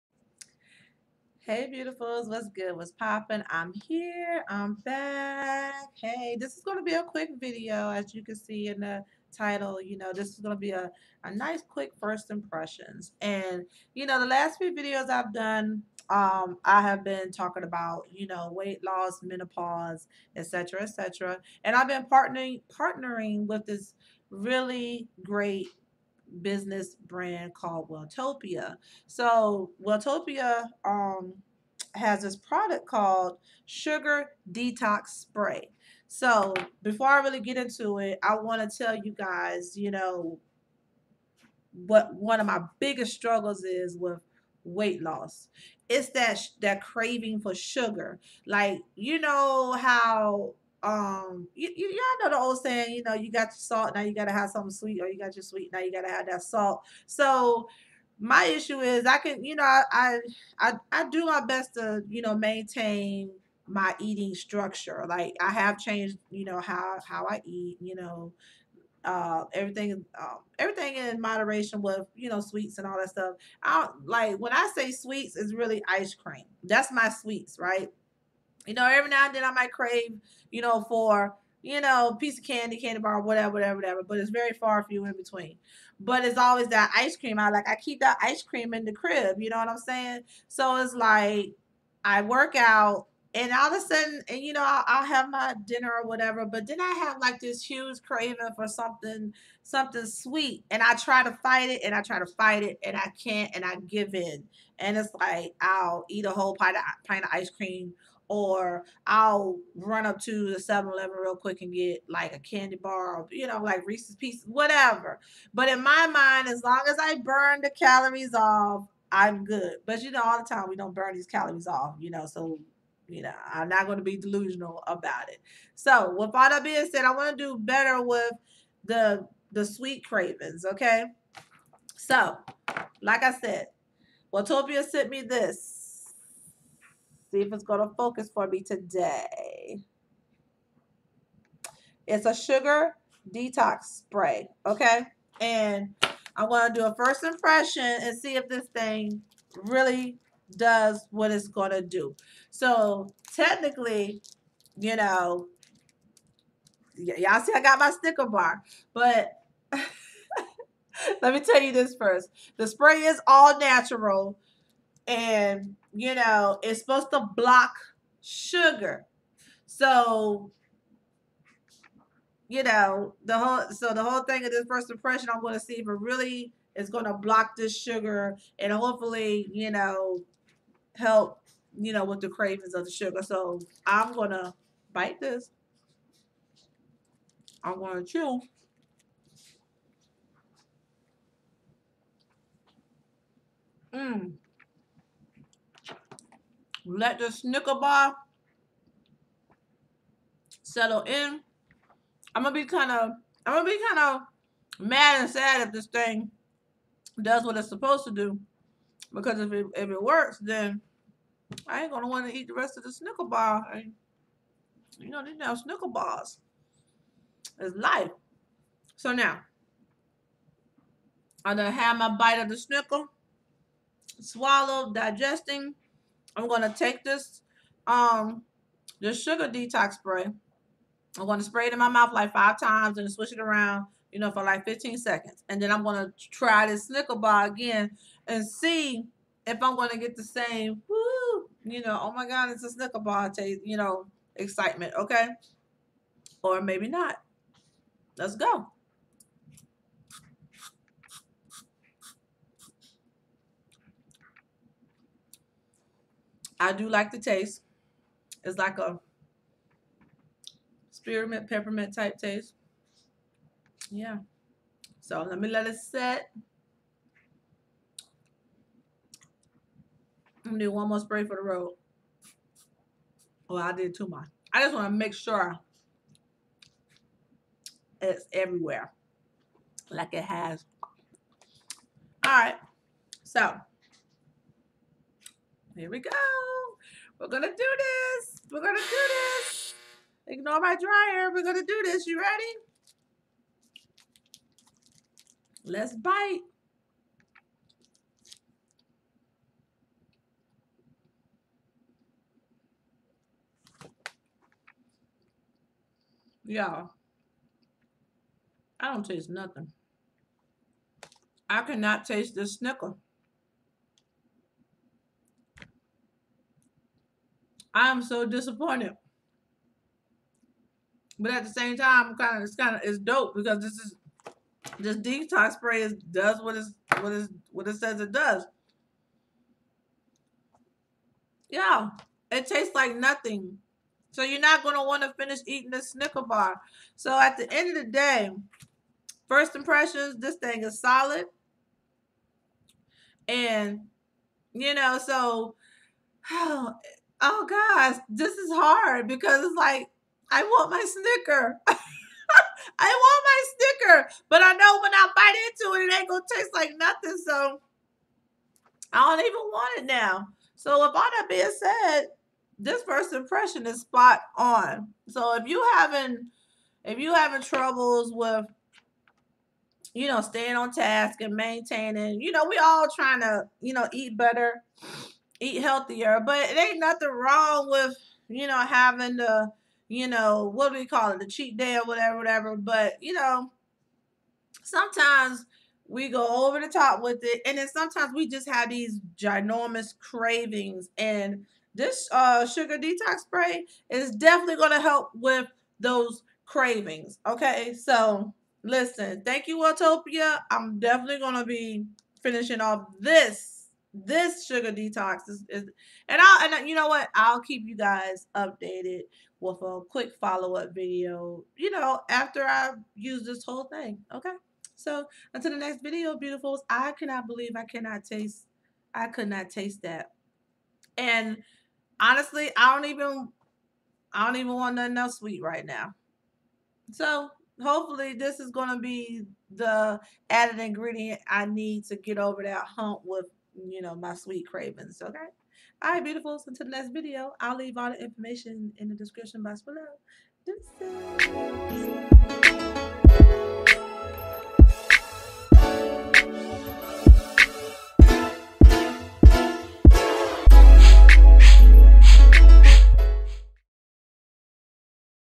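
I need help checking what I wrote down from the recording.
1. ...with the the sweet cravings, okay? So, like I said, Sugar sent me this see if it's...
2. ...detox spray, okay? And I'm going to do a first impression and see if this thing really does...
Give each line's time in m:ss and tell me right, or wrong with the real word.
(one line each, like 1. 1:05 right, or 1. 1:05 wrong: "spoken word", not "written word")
1. 2:08 wrong: "Welltopia", not "Sugar"
2. 2:23 right.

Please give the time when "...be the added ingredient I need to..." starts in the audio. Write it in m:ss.
7:08.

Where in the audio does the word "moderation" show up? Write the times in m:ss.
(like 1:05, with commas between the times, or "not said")
1:11.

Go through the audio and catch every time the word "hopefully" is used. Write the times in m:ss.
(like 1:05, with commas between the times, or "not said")
2:58, 7:07.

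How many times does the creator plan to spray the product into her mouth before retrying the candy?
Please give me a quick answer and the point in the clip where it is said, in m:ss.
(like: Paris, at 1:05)
5, at 3:52.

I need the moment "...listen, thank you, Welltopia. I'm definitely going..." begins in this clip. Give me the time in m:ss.
6:38.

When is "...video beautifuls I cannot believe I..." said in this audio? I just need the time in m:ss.
6:55.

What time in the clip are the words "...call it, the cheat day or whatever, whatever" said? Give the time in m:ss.
6:20.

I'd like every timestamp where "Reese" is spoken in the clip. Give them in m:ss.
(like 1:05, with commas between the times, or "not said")
1:53.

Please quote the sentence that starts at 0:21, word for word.
And I've been partnering, partnering with this really great business brand called Welltopia.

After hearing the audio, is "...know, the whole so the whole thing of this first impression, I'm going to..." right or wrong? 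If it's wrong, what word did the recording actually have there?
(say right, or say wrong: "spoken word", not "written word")
right.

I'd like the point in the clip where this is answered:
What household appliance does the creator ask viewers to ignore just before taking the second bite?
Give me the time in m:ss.
4:50.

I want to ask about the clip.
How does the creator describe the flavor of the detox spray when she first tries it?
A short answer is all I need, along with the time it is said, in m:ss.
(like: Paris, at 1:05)
spearmint, peppermint, at 4:20.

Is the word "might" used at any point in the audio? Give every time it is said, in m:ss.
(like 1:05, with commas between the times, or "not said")
1:19.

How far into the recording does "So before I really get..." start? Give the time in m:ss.
0:36.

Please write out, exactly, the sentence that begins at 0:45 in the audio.
It's that that craving for sugar.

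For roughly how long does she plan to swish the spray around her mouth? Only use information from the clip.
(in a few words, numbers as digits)
15 seconds.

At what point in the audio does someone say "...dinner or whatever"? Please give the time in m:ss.
1:35.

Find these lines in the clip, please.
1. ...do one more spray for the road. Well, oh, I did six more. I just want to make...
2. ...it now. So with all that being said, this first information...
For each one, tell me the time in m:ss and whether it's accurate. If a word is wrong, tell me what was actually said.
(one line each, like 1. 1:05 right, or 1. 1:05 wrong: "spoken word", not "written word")
1. 4:30 wrong: "two", not "six"
2. 5:59 wrong: "impression", not "information".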